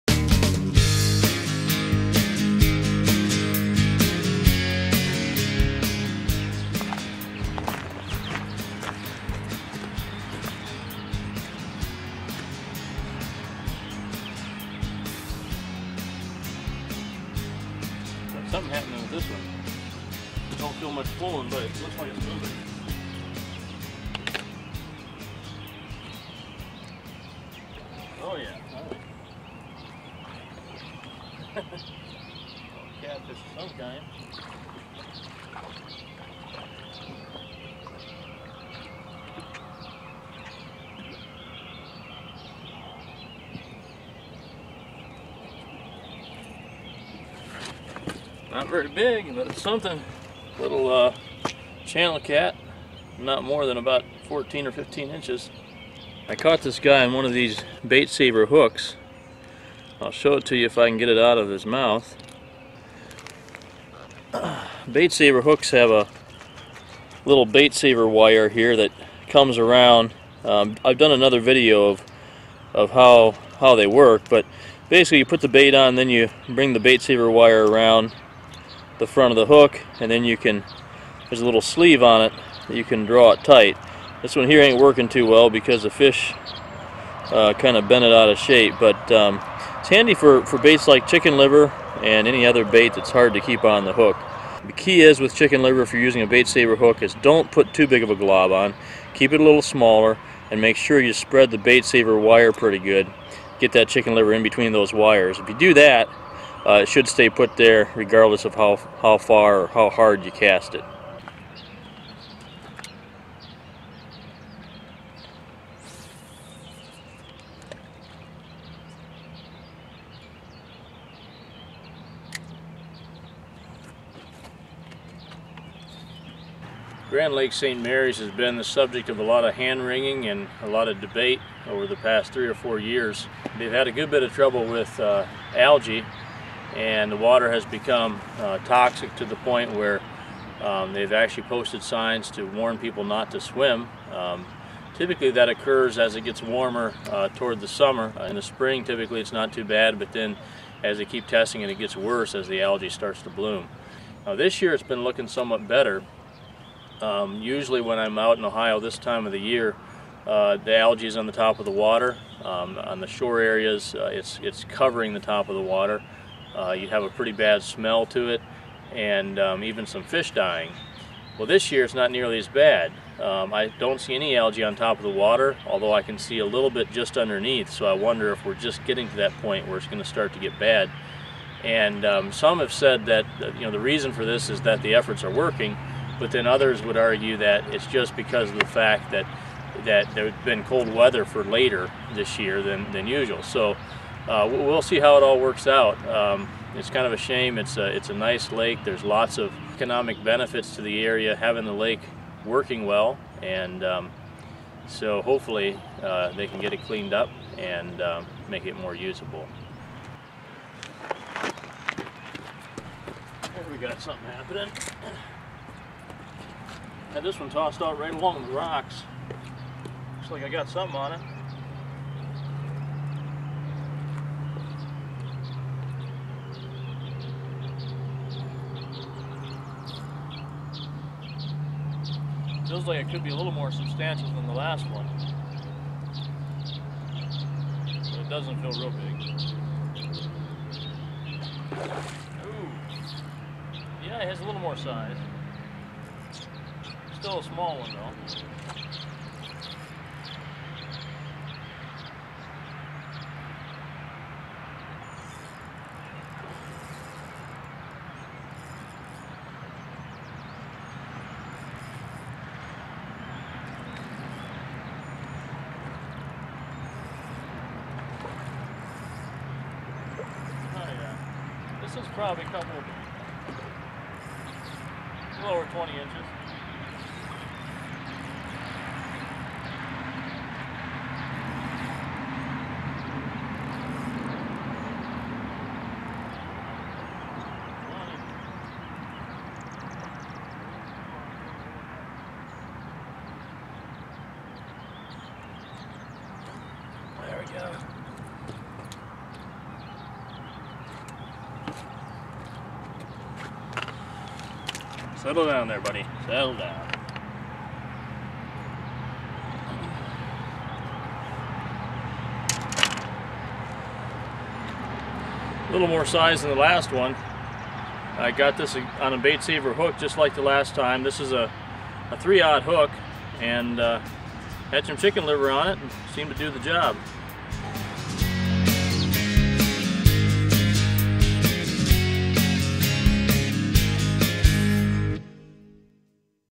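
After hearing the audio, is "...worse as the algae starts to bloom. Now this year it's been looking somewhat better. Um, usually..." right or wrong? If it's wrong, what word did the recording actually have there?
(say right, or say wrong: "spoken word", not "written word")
right.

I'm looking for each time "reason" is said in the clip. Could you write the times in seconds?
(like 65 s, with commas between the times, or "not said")
183 s.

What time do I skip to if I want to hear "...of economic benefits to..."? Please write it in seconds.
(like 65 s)
199 s.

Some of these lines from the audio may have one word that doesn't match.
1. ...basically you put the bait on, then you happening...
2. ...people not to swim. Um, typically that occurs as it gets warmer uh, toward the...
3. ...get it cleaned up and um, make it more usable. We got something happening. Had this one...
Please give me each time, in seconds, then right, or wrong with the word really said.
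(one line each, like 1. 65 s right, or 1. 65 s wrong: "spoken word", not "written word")
1. 74 s wrong: "bring", not "happening"
2. 142 s right
3. 206 s right.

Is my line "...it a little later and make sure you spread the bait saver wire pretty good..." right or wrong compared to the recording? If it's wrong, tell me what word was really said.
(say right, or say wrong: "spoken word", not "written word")
wrong: "smaller", not "later".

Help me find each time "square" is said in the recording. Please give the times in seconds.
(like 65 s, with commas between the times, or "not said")
not said.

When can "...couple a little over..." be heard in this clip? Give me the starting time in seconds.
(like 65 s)
272 s.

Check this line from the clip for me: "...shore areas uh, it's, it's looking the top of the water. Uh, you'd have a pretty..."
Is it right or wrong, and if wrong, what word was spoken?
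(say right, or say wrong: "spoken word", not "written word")
wrong: "covering", not "looking".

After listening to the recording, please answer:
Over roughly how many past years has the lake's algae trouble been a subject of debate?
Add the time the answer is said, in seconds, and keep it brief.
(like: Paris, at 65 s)
three or four years, at 132 s.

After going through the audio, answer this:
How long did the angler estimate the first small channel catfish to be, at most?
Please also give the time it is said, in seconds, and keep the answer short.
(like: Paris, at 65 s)
14 or 15 inches, at 54 s.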